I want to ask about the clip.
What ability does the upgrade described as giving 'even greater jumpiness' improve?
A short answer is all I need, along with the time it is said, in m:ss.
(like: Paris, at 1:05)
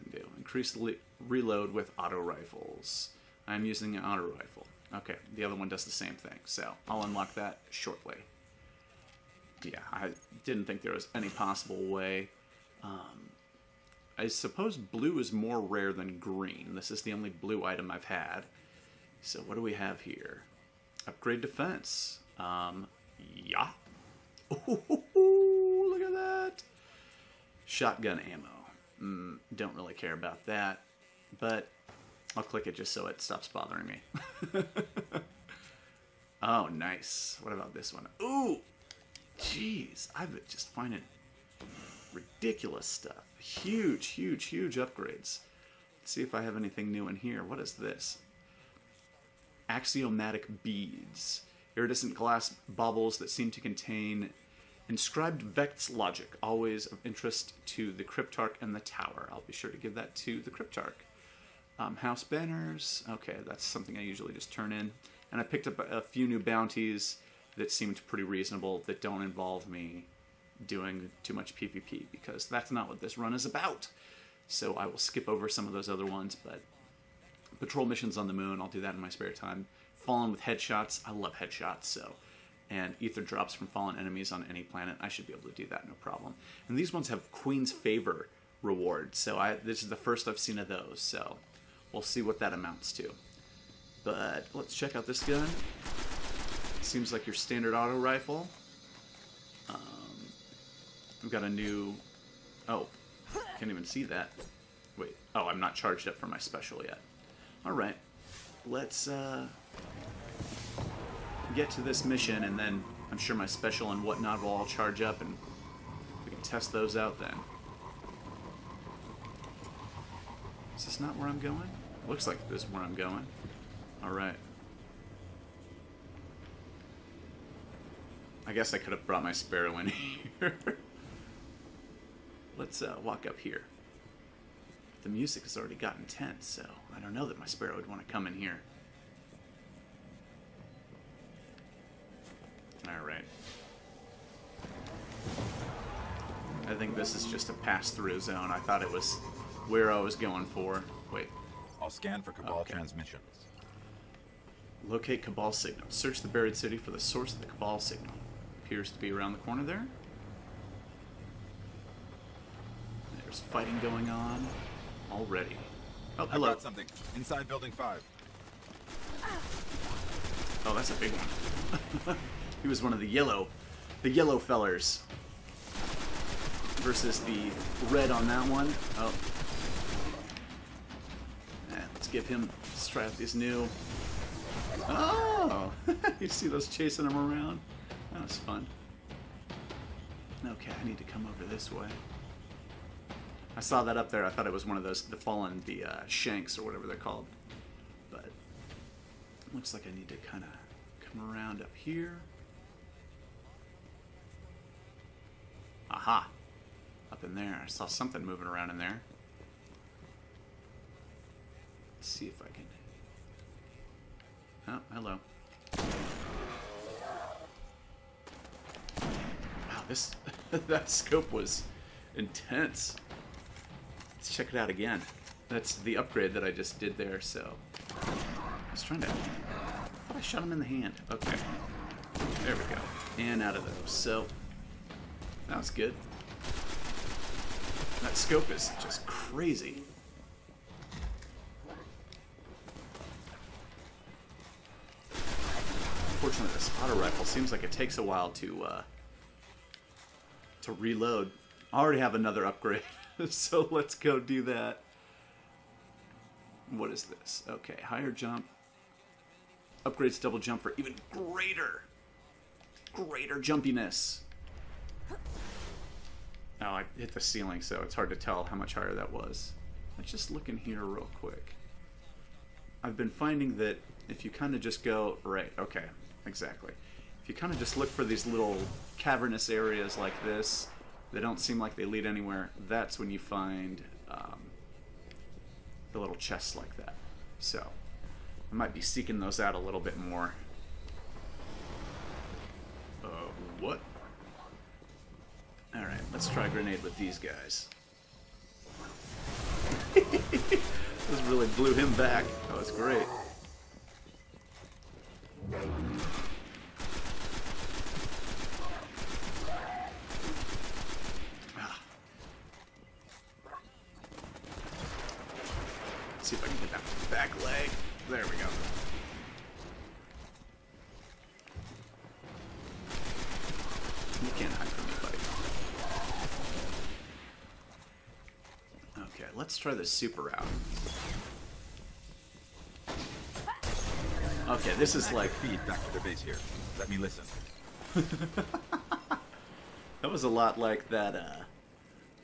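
Double jump, at 4:20.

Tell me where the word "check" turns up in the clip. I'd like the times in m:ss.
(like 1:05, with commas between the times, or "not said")
1:34, 3:44.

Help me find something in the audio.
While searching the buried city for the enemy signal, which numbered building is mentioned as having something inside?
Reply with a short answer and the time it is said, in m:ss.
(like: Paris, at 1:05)
Building Five, at 2:47.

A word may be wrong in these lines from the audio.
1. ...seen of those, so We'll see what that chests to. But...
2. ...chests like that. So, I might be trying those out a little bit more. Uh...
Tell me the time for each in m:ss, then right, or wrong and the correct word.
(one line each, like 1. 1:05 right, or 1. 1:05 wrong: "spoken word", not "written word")
1. 1:30 wrong: "amounts", not "chests"
2. 4:46 wrong: "seeking", not "trying".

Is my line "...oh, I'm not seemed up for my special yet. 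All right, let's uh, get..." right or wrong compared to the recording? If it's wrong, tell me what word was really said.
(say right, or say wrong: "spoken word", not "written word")
wrong: "charged", not "seemed".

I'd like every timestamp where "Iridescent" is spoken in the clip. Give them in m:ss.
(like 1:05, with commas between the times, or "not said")
0:51.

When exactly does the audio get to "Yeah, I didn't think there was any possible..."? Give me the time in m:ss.
0:09.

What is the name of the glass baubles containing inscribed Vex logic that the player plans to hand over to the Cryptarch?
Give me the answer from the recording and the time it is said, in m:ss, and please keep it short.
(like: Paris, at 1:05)
Axiomatic beads, at 0:49.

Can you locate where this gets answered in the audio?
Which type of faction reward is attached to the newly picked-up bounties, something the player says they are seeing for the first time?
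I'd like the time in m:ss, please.
1:27.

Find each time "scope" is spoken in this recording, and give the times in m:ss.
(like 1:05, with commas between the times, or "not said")
3:40, 3:58.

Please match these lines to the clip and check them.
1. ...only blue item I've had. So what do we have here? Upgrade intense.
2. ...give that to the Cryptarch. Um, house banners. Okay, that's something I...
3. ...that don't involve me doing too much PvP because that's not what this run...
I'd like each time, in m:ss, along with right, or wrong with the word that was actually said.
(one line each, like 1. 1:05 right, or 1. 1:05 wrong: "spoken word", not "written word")
1. 0:17 wrong: "defense", not "intense"
2. 0:59 right
3. 1:08 right.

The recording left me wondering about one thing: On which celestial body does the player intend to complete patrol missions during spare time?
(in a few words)
the moon.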